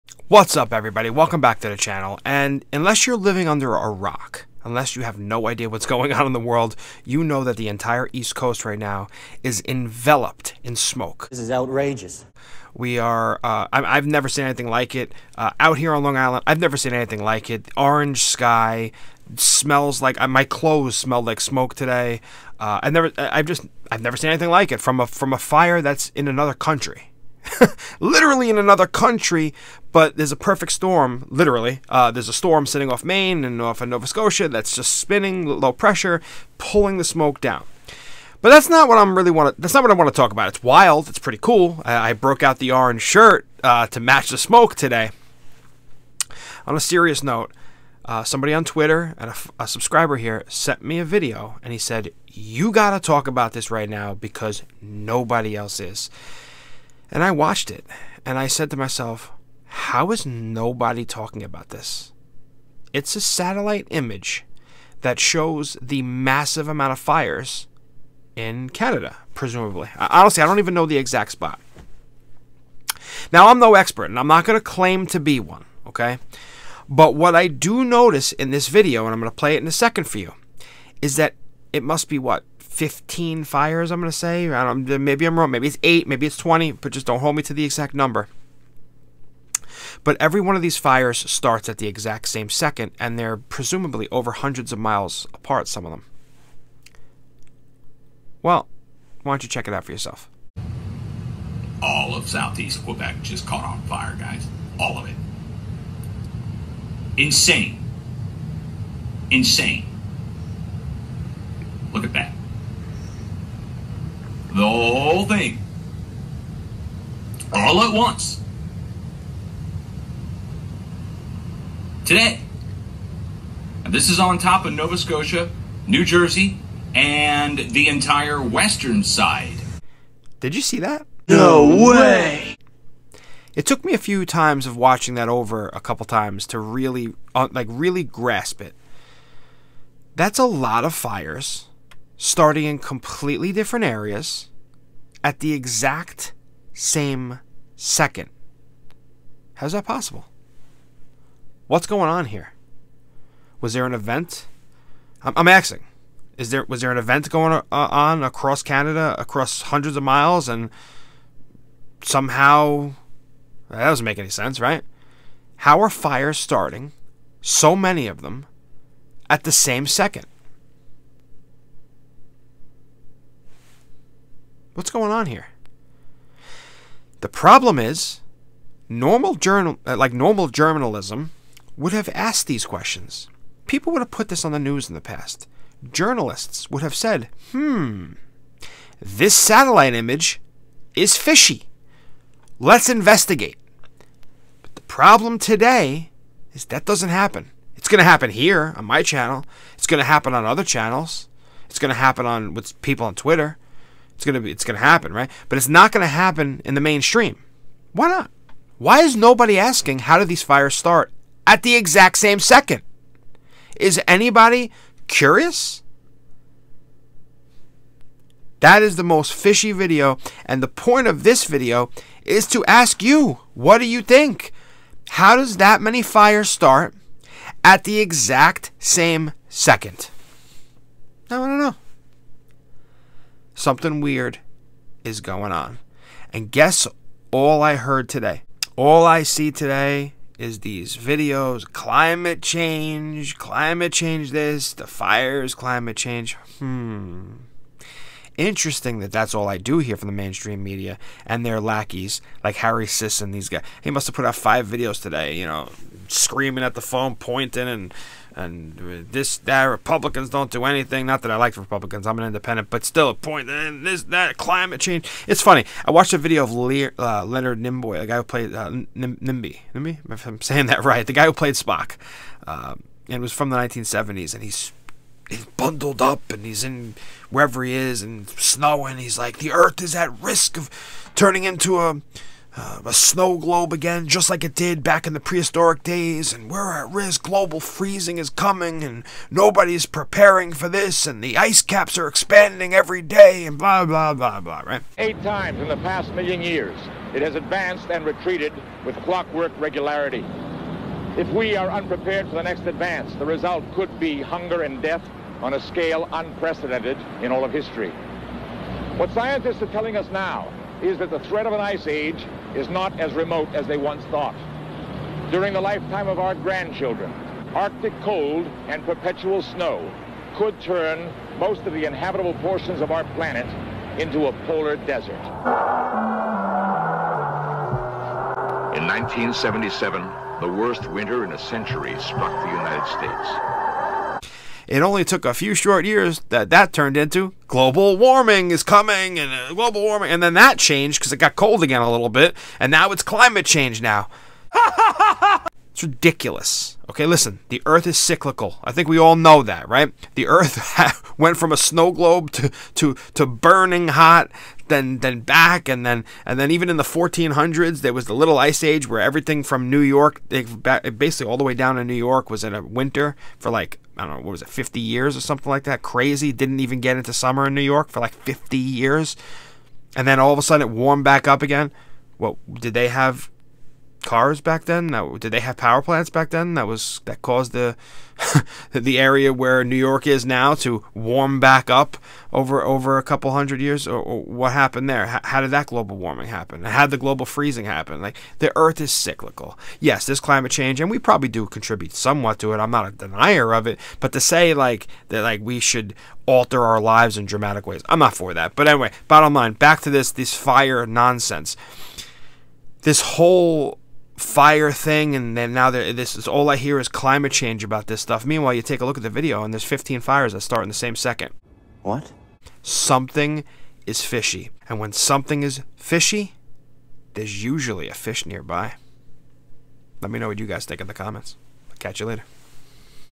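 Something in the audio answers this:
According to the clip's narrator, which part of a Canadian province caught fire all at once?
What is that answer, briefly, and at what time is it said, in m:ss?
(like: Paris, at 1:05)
Southeast Quebec, at 1:42.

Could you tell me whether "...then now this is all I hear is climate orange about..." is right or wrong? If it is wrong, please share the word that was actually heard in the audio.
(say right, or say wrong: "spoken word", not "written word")
wrong: "change", not "orange".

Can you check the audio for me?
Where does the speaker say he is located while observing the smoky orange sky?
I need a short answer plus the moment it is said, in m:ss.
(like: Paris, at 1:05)
Long Island, at 0:16.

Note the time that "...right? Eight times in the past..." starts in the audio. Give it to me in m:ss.
4:54.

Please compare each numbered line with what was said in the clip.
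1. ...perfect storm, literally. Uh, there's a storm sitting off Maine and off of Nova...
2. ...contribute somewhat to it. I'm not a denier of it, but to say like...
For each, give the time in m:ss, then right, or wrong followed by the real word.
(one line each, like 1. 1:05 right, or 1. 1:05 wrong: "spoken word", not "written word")
1. 0:30 right
2. 6:31 right.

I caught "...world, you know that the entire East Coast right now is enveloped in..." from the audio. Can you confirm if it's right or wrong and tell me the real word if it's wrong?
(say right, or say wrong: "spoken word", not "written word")
right.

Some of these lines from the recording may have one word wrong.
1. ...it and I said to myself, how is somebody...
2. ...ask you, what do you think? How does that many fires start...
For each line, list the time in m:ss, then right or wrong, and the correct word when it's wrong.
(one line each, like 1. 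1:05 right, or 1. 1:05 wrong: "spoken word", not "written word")
1. 0:57 wrong: "nobody", not "somebody"
2. 3:42 right.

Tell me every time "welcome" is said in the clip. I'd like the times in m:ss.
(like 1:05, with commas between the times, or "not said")
0:01.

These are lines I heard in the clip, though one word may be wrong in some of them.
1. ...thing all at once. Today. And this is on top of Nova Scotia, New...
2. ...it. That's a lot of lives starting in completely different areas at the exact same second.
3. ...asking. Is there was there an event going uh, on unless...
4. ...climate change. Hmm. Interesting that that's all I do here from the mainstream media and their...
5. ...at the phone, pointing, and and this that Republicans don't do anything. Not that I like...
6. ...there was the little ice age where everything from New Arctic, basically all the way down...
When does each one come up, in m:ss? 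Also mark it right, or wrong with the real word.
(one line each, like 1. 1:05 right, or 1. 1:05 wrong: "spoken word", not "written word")
1. 1:55 right
2. 2:18 wrong: "fires", not "lives"
3. 2:35 wrong: "across", not "unless"
4. 4:05 right
5. 4:16 right
6. 5:57 wrong: "York", not "Arctic".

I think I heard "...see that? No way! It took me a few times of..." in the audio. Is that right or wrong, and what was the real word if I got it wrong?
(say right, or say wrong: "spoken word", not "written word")
right.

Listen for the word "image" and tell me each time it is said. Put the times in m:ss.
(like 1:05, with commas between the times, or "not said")
1:03, 3:09.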